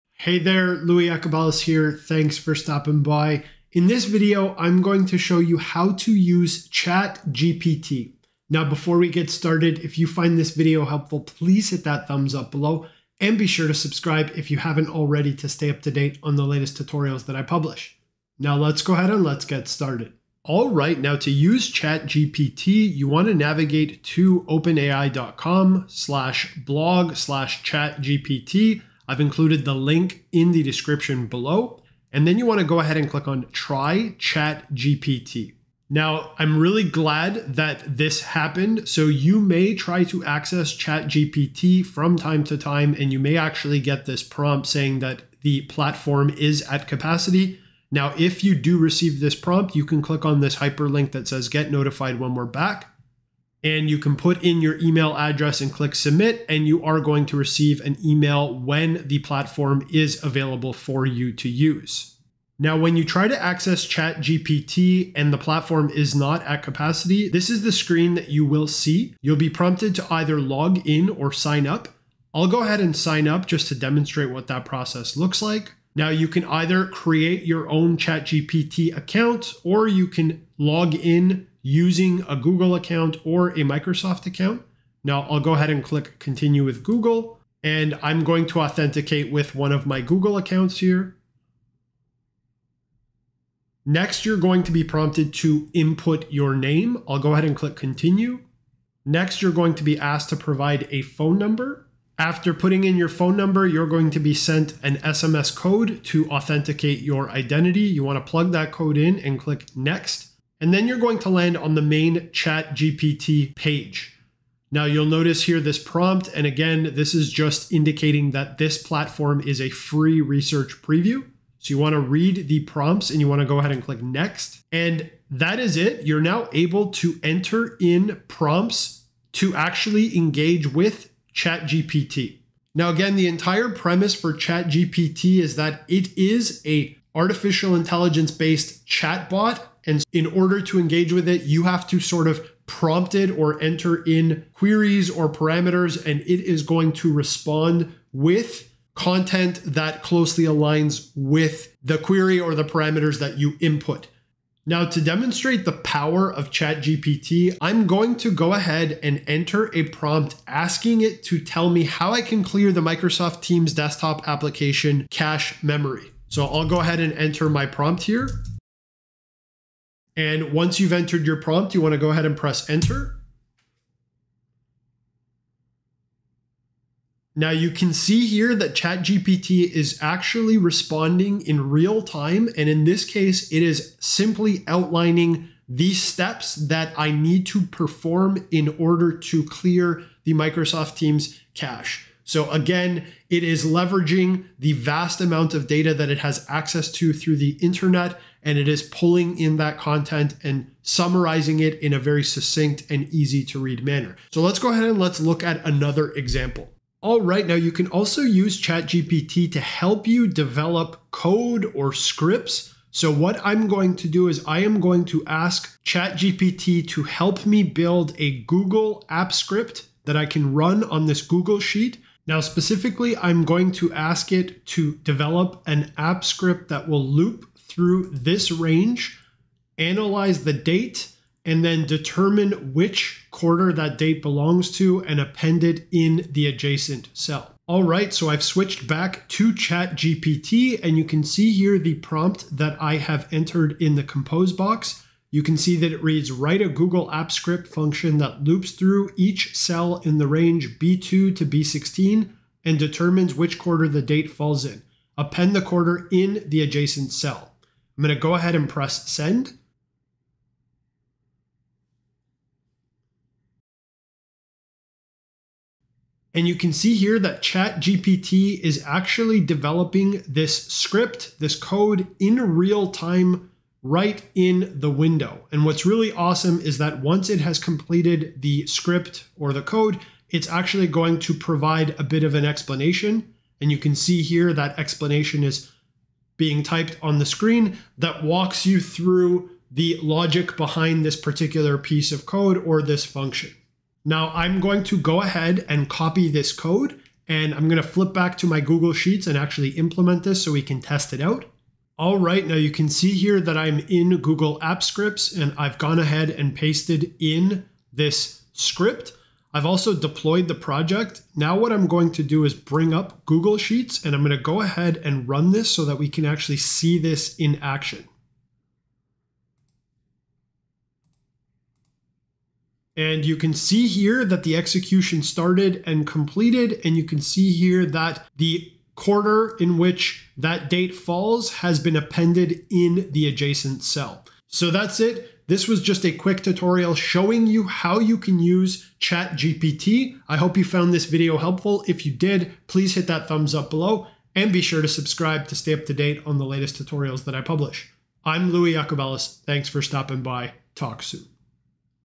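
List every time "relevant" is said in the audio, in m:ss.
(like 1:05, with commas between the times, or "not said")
not said.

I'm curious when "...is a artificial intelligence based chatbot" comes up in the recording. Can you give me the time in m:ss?
2:16.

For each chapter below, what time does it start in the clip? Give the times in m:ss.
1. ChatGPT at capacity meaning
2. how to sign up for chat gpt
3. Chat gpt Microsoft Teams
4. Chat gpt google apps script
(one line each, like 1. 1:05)
1. 0:20
2. 1:00
3. 2:40
4. 3:27.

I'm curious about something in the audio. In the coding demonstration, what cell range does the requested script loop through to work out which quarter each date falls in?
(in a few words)
B2 to B16.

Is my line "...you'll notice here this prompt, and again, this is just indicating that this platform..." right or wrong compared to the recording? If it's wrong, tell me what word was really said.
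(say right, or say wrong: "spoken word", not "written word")
right.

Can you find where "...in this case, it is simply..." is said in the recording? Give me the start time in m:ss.
3:02.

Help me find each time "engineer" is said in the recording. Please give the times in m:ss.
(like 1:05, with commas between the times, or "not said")
not said.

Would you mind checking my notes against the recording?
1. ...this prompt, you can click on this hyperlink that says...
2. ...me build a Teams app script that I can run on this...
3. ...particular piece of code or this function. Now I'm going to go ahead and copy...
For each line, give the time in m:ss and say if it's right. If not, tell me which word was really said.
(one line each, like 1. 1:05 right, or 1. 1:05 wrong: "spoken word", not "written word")
1. 0:49 right
2. 3:37 wrong: "Google", not "Teams"
3. 4:51 right.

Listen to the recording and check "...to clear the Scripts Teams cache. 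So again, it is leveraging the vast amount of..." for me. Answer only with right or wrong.
wrong.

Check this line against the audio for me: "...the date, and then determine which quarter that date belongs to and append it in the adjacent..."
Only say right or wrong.
right.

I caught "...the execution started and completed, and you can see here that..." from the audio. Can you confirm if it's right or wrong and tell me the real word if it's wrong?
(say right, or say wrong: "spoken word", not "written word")
right.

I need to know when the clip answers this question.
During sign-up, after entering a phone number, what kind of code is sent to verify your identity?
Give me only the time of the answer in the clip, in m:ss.
1:44.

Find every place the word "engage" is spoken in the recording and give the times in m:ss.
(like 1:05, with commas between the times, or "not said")
2:10, 2:20.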